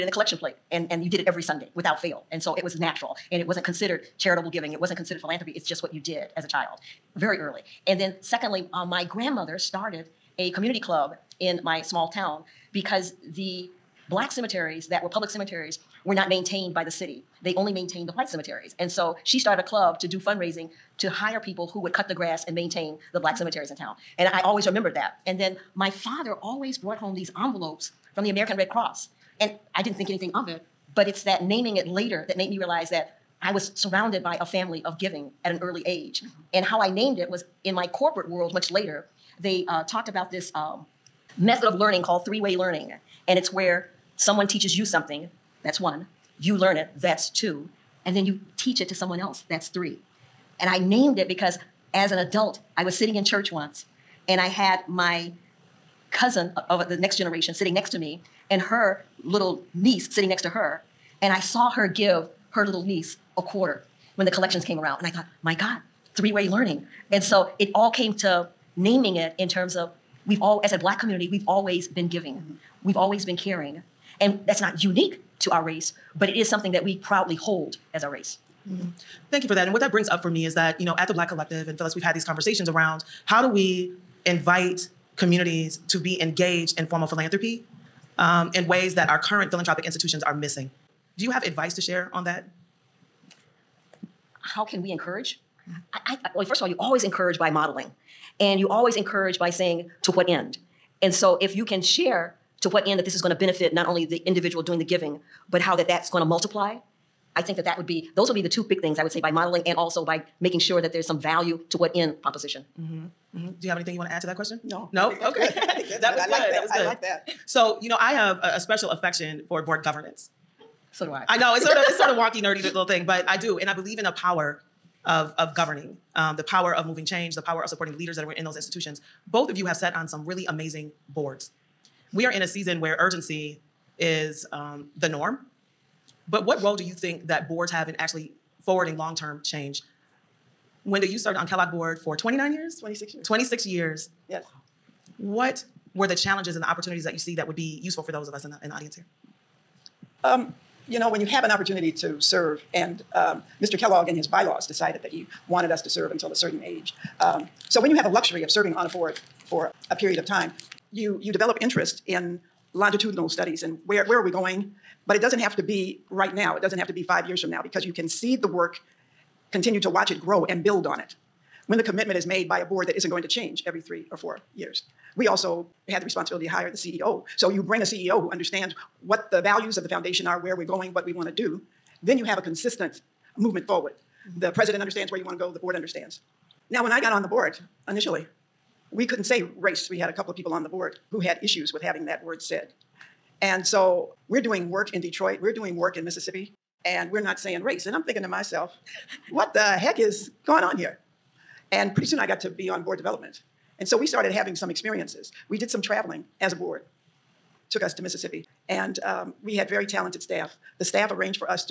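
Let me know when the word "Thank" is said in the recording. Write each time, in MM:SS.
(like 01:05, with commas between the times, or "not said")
01:19.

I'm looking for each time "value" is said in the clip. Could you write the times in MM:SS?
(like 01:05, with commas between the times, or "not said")
01:51, 02:59.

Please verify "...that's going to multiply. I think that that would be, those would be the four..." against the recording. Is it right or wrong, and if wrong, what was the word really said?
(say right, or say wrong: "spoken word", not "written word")
wrong: "two", not "four".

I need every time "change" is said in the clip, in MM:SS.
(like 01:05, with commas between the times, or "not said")
02:07, 02:19, 02:53.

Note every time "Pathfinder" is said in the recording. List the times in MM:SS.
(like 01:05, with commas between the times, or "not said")
not said.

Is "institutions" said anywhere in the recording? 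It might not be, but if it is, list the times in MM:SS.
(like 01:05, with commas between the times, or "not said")
01:29, 02:08.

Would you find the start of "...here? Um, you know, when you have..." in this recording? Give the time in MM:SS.
02:28.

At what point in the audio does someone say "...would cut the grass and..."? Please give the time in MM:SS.
00:21.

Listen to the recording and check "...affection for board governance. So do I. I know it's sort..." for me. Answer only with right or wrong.
right.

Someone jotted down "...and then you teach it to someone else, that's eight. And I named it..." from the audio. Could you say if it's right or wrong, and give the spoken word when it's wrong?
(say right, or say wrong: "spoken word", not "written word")
wrong: "three", not "eight".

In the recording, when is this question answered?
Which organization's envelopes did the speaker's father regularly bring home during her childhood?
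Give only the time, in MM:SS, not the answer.
00:28.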